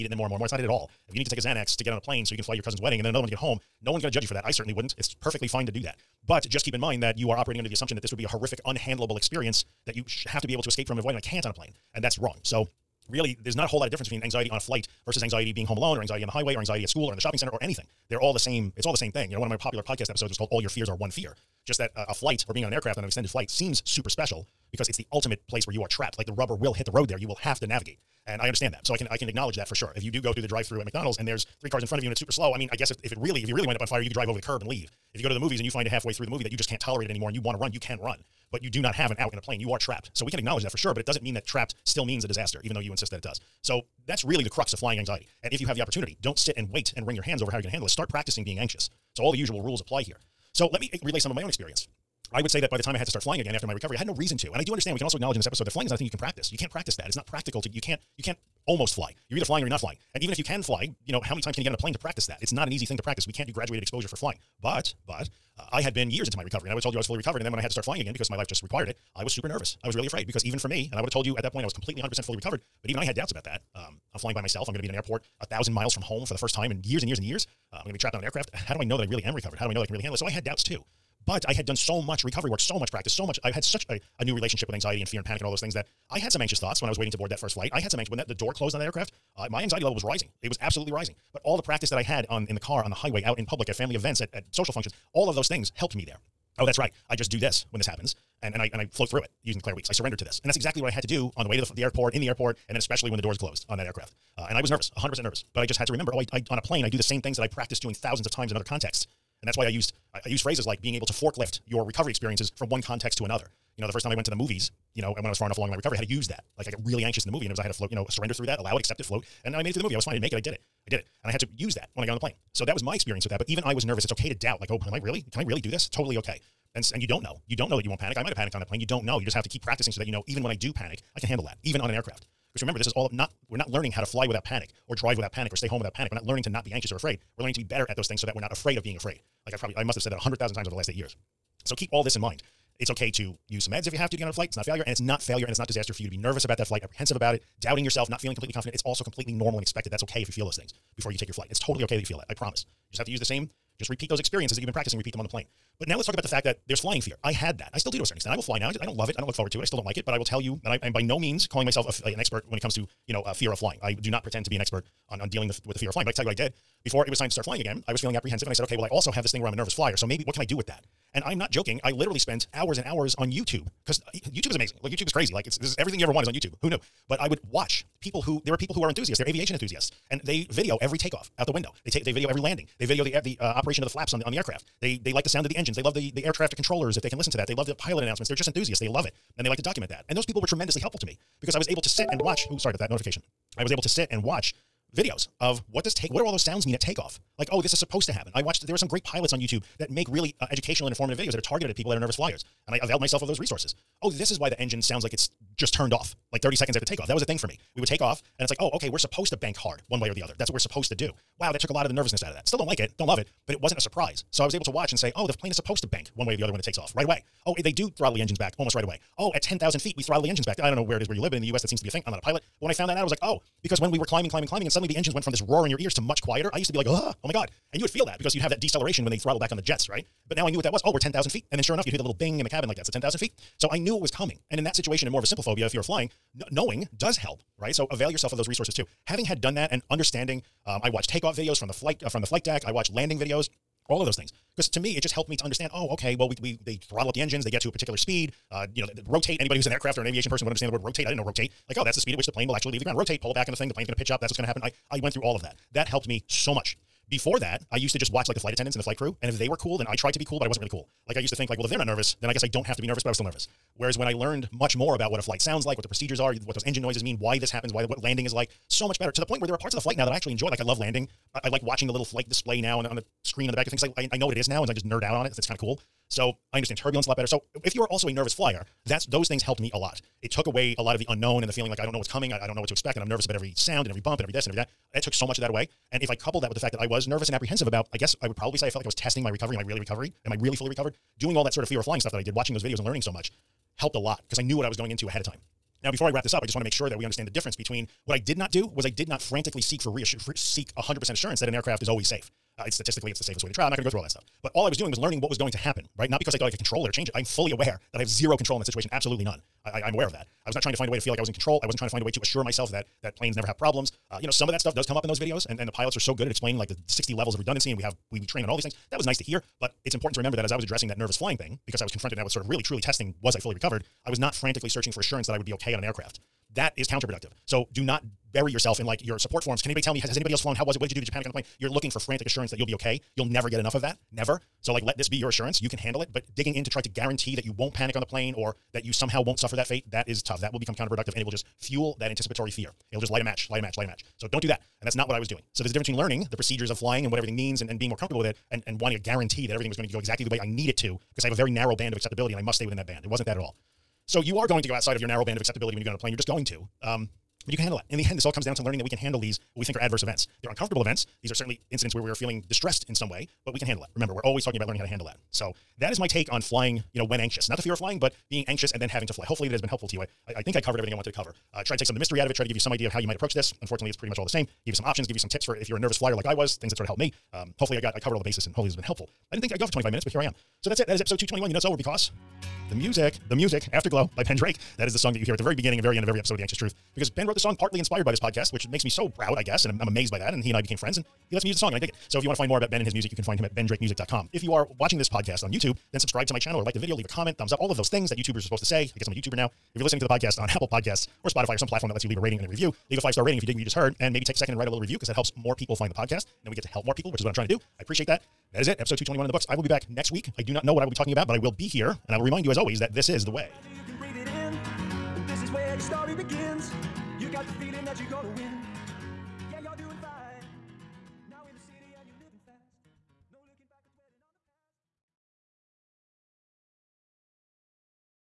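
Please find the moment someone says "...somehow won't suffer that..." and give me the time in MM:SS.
05:38.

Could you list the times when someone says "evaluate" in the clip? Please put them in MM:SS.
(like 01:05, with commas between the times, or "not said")
not said.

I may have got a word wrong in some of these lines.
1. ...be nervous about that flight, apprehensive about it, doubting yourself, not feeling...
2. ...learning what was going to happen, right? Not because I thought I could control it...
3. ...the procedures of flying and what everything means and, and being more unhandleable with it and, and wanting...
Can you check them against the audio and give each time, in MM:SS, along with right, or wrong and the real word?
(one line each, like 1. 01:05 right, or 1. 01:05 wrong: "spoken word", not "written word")
1. 02:26 right
2. 05:04 right
3. 05:46 wrong: "comfortable", not "unhandleable".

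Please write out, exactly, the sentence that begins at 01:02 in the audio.
It's not an easy thing to practice.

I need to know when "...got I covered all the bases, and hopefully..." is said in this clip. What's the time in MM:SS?
06:17.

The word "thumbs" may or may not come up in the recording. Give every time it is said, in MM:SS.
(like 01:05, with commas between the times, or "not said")
06:37.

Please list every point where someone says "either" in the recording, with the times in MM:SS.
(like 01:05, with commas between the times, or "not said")
00:59.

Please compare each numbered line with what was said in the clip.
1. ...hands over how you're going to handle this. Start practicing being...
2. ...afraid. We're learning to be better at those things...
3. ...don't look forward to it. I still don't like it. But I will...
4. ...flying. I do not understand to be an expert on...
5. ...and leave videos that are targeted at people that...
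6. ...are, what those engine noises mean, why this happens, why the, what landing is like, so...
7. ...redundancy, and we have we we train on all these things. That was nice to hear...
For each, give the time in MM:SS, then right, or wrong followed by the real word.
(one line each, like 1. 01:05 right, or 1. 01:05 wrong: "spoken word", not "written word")
1. 00:47 right
2. 02:16 right
3. 02:39 right
4. 02:43 wrong: "pretend", not "understand"
5. 03:20 wrong: "informative", not "leave"
6. 04:26 right
7. 05:17 right.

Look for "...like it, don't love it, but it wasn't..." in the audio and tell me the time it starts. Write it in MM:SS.
03:32.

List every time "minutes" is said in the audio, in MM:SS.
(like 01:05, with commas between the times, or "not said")
06:19.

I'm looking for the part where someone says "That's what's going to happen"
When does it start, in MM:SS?
04:14.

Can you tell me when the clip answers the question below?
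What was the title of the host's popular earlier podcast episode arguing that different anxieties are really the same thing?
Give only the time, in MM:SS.
00:20.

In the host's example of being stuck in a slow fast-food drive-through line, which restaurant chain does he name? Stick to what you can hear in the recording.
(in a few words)
McDonald's.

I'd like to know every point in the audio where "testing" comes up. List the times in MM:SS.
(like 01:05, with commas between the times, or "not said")
04:48, 05:22.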